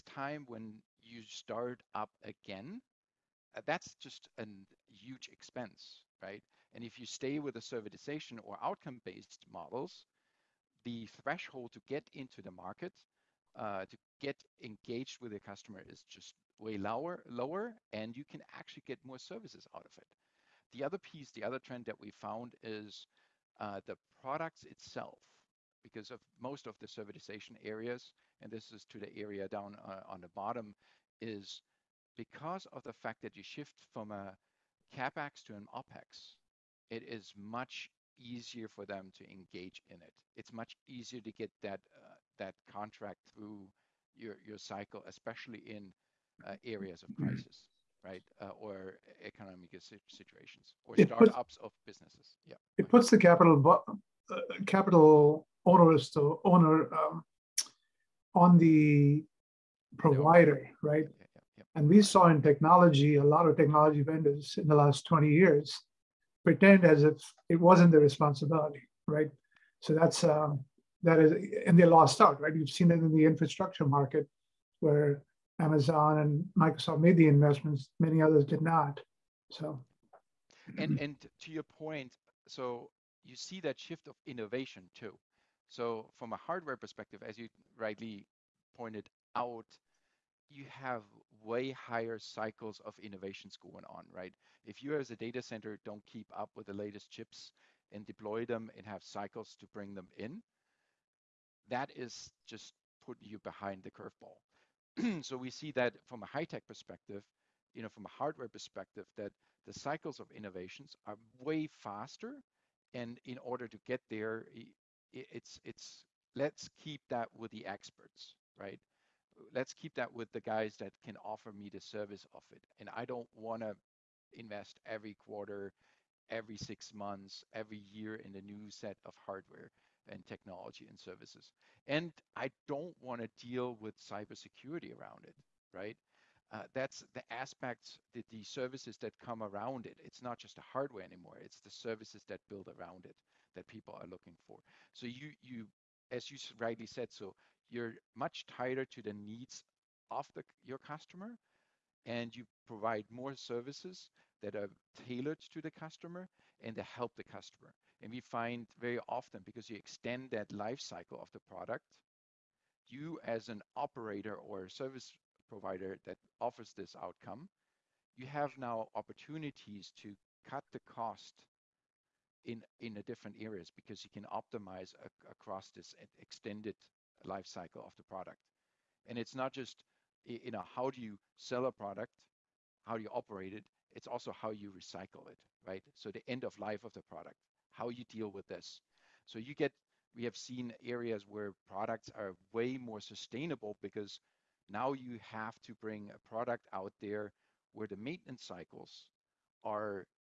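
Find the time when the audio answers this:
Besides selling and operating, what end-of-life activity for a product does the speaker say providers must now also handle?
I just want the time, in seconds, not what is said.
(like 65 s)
184 s.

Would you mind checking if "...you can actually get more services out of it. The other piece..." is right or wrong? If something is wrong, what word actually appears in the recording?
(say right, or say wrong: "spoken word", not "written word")
right.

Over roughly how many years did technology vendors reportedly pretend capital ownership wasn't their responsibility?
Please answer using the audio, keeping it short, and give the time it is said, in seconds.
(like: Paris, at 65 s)
20 years, at 65 s.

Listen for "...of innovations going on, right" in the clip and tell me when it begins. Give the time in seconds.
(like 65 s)
92 s.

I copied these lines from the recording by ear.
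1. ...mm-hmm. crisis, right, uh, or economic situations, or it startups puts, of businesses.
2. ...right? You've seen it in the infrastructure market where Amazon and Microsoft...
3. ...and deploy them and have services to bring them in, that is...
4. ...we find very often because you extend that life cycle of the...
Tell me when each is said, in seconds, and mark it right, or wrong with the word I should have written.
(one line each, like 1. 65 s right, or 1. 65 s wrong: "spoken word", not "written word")
1. 47 s right
2. 72 s right
3. 97 s wrong: "cycles", not "services"
4. 158 s right.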